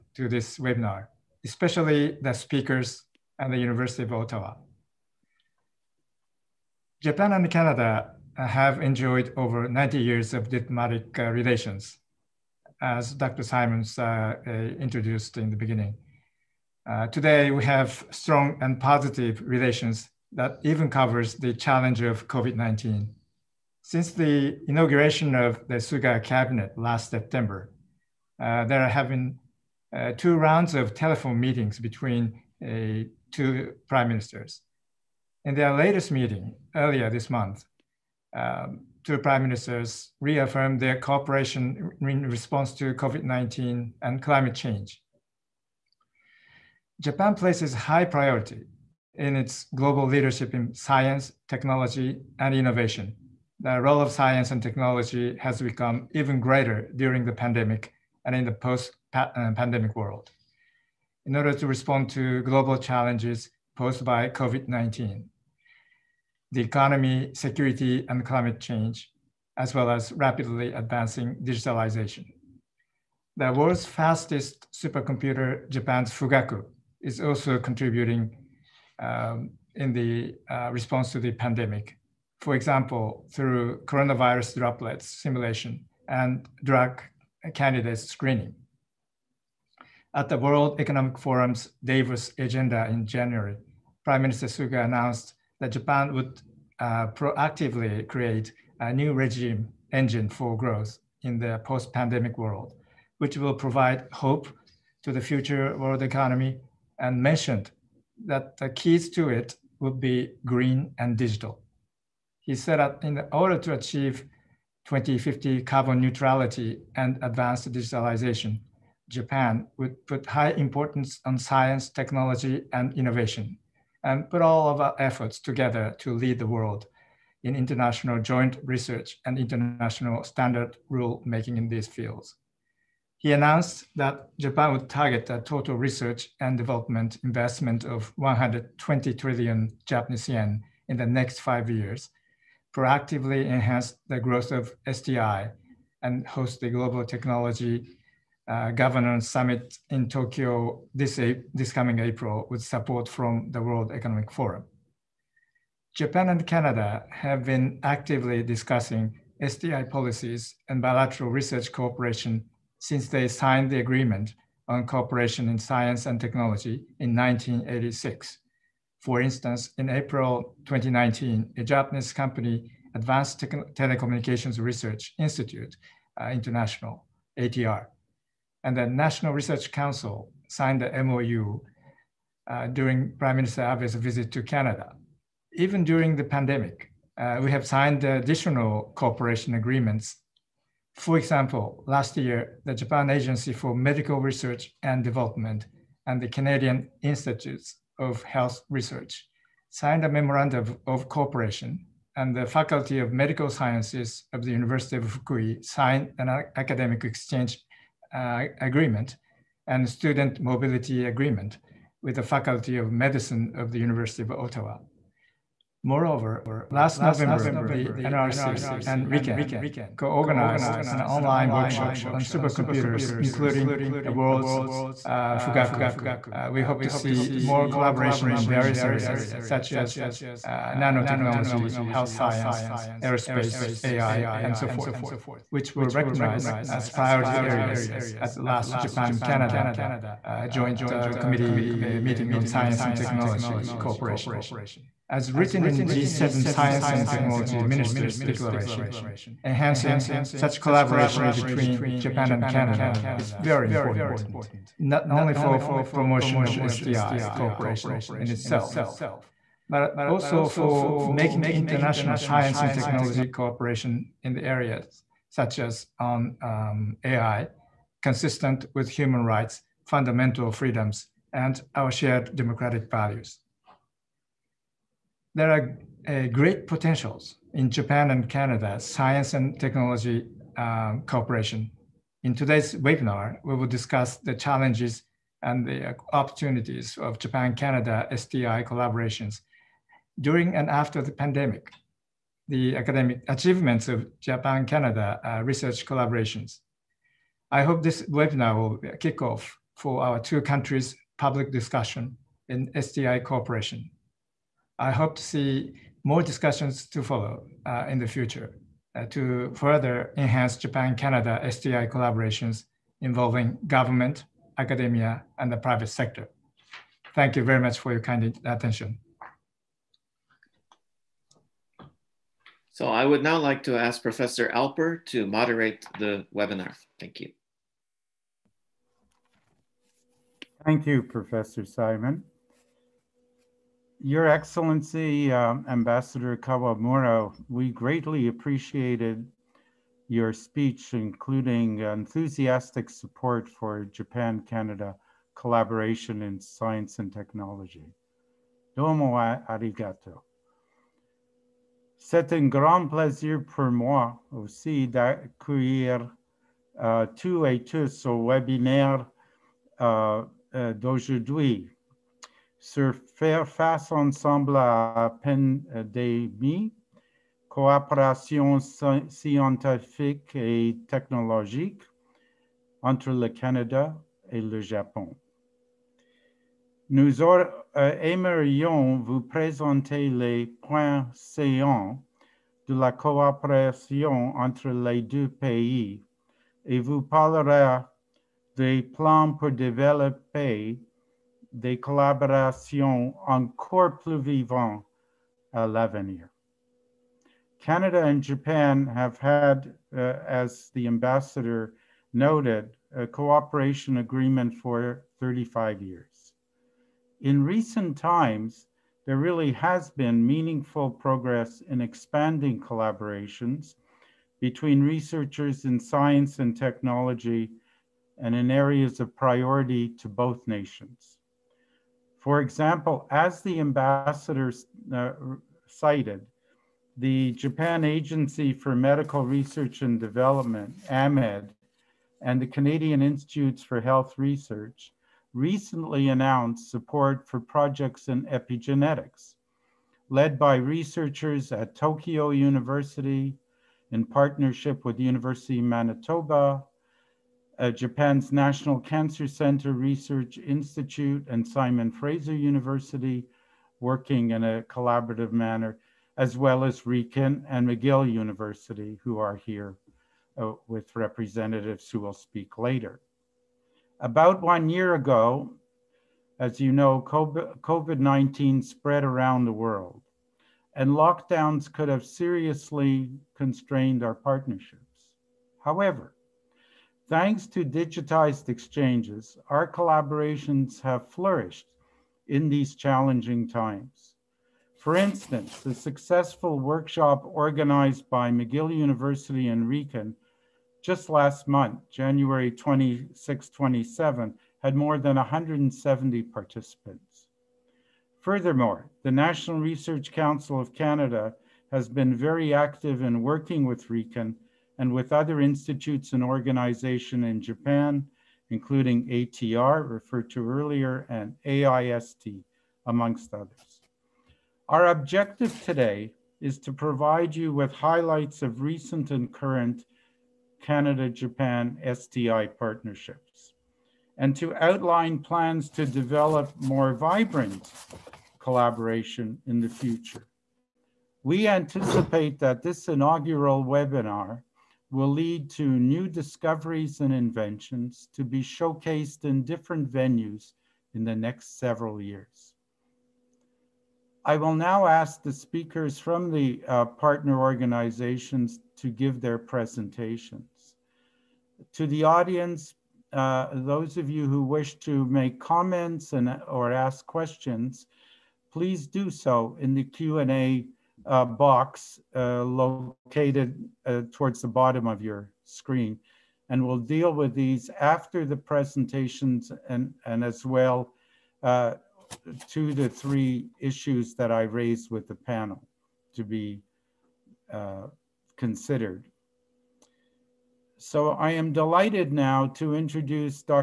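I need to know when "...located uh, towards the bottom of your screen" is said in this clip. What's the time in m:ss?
9:22.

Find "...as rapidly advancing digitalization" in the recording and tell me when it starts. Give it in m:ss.
1:09.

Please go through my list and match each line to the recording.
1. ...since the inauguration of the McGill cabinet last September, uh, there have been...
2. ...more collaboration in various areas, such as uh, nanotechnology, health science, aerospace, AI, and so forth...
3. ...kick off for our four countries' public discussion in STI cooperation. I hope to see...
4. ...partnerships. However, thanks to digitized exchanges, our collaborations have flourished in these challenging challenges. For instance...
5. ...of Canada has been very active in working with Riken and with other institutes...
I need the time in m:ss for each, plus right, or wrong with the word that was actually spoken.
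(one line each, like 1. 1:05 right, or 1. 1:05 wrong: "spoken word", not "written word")
1. 0:23 wrong: "Suga", not "McGill"
2. 3:47 right
3. 4:58 wrong: "two", not "four"
4. 7:54 wrong: "times", not "challenges"
5. 8:20 right.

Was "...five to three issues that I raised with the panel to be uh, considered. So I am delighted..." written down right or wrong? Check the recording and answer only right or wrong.
wrong.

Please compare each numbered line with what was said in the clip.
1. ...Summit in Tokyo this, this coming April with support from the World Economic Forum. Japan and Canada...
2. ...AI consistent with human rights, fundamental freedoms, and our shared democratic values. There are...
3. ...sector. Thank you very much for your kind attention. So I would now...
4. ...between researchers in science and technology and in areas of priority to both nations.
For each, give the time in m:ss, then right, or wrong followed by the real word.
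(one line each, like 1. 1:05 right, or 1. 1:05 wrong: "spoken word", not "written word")
1. 2:29 right
2. 4:27 right
3. 5:15 right
4. 6:54 right.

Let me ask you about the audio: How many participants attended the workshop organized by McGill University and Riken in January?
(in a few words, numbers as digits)
more than 170.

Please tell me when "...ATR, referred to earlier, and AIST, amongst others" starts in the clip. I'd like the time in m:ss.
8:29.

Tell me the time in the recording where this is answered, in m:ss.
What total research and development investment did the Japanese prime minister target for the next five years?
2:18.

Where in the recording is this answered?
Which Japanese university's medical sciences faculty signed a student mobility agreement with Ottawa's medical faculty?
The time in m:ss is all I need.
3:24.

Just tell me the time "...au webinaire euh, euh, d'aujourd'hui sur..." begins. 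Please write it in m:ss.
5:58.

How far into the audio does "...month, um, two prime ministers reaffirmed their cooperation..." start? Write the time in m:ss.
0:37.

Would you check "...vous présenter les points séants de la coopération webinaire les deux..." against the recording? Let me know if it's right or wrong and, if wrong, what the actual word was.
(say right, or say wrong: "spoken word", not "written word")
wrong: "entre", not "webinaire".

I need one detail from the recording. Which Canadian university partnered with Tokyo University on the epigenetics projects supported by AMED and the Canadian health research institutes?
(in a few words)
University of Manitoba.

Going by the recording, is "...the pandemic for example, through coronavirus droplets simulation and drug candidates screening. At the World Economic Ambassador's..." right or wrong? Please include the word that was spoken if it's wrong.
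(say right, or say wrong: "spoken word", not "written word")
wrong: "Forum", not "Ambassador".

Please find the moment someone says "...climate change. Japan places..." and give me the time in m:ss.
0:44.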